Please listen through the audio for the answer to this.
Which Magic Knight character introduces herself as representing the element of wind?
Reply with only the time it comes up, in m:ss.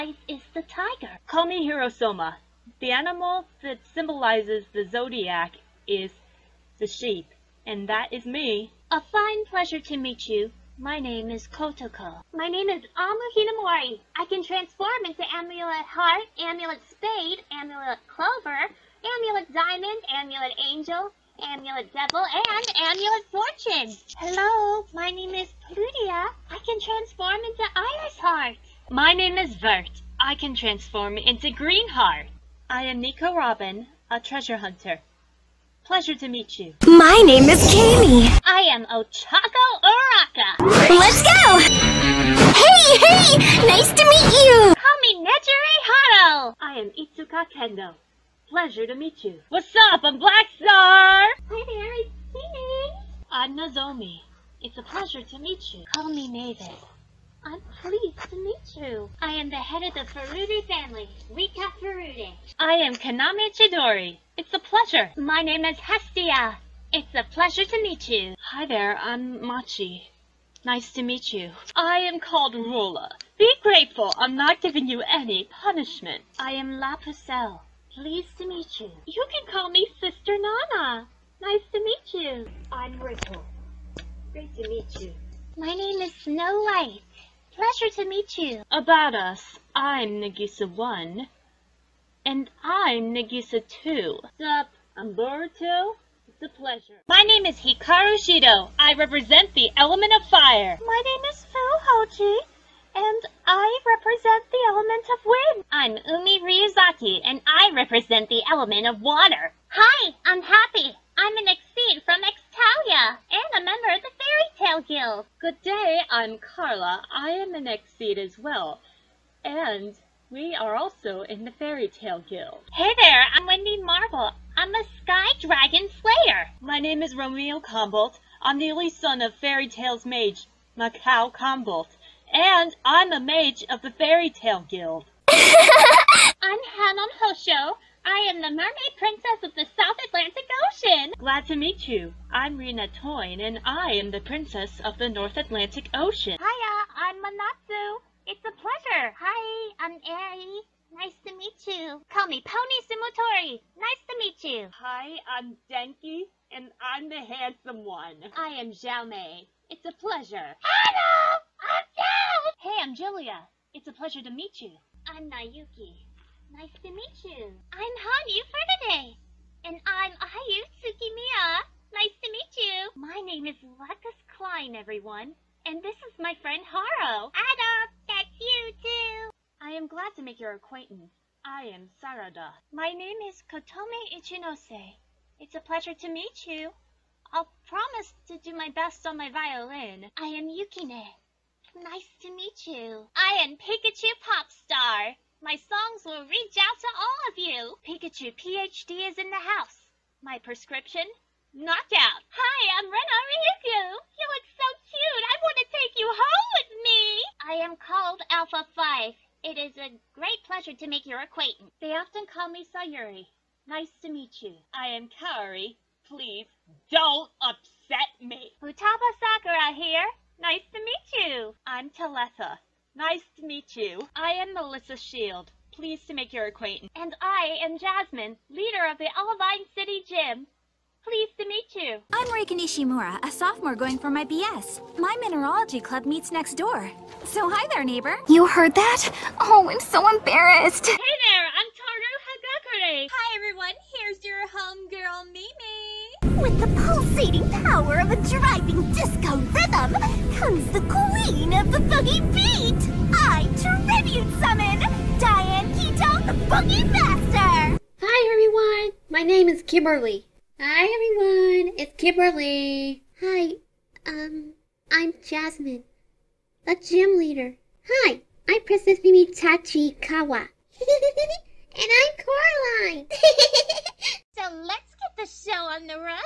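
1:41.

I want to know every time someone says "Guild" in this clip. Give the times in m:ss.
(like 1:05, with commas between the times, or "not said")
1:54, 2:02, 2:14.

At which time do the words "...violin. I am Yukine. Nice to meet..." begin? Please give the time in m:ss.
3:09.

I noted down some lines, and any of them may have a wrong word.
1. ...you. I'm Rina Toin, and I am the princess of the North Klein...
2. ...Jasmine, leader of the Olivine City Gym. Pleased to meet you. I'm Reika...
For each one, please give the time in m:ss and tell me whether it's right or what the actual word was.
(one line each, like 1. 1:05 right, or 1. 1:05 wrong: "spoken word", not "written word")
1. 2:21 wrong: "Atlantic", not "Klein"
2. 3:47 right.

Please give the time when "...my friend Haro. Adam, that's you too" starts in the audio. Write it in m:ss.
2:56.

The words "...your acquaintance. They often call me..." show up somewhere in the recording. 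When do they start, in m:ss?
3:31.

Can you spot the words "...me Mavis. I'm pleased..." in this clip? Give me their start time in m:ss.
0:56.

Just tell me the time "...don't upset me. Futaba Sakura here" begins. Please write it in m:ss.
3:36.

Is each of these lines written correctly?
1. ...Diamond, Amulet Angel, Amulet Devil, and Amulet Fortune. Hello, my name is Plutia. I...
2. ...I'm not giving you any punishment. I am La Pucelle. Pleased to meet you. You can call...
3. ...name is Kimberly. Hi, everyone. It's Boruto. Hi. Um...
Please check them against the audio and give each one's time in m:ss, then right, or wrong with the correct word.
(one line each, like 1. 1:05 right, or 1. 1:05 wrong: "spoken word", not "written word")
1. 0:19 right
2. 1:14 right
3. 4:19 wrong: "Kimberly", not "Boruto".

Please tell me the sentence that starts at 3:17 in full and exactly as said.
Pikachu PhD is in the house.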